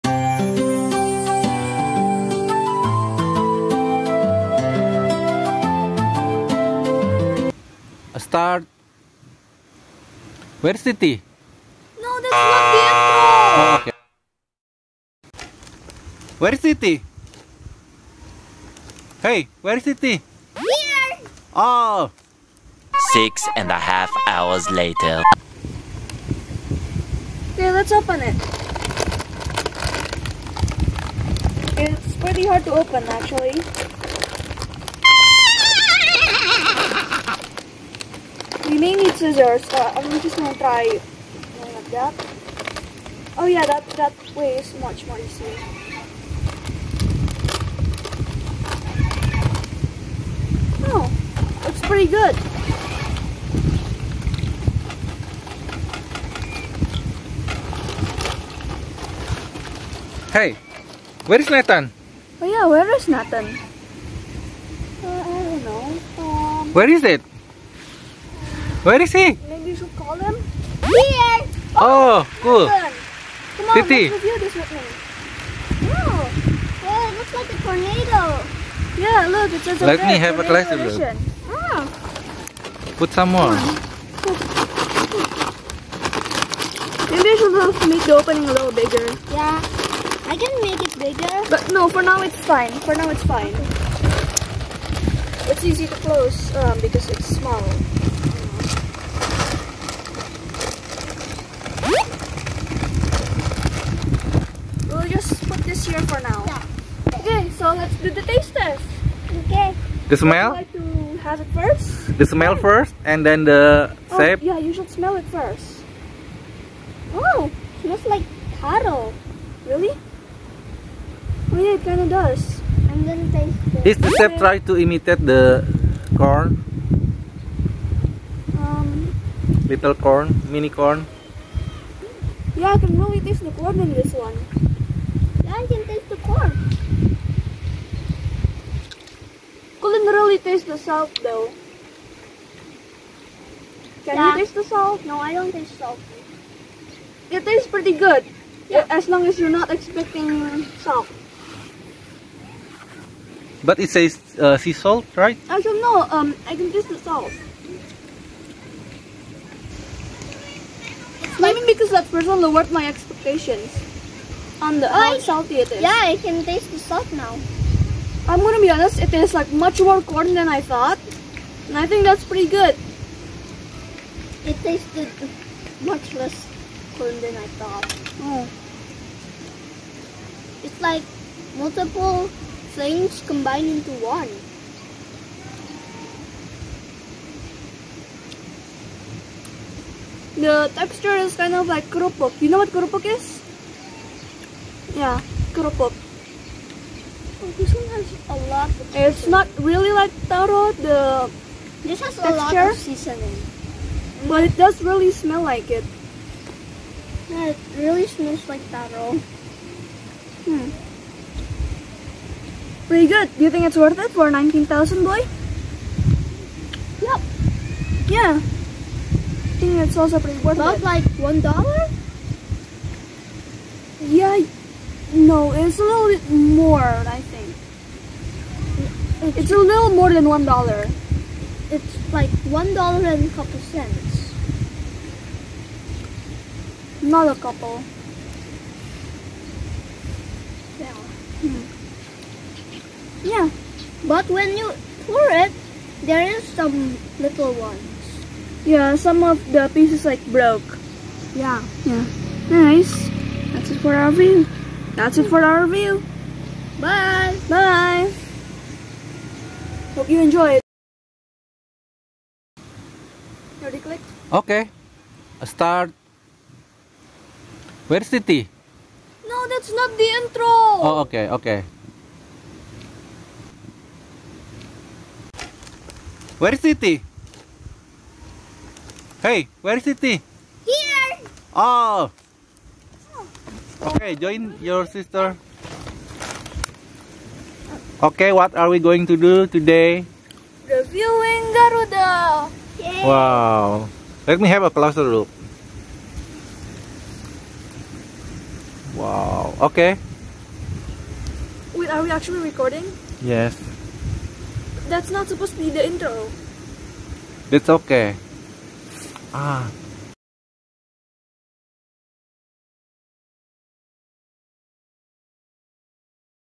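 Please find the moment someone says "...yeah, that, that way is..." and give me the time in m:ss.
0:43.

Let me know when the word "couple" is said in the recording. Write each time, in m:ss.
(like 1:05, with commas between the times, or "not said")
3:53, 3:57.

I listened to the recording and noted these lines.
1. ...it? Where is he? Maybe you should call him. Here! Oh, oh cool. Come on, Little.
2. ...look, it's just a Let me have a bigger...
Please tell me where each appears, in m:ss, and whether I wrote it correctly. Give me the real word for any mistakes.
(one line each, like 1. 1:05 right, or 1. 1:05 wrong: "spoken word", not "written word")
1. 1:07 wrong: "Titi", not "Little"
2. 1:19 wrong: "closer", not "bigger".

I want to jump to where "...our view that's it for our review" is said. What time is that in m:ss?
4:13.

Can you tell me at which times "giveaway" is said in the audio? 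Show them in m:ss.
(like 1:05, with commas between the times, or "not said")
not said.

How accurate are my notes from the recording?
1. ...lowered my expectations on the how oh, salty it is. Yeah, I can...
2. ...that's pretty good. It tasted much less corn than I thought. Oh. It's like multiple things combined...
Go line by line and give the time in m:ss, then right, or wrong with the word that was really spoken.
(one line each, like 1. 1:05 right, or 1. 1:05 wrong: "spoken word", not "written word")
1. 2:42 right
2. 2:52 right.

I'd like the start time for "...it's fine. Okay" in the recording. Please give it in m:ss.
1:33.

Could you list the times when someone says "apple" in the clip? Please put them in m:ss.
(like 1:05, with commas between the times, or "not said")
0:12.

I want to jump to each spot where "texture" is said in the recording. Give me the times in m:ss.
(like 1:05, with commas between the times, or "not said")
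3:10, 3:22.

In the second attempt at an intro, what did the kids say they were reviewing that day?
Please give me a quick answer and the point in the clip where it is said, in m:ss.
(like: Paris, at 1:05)
Garuda, at 4:50.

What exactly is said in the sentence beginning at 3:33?
Do you think it's worth it for 19,000, boy?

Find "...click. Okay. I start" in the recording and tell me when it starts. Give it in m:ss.
4:23.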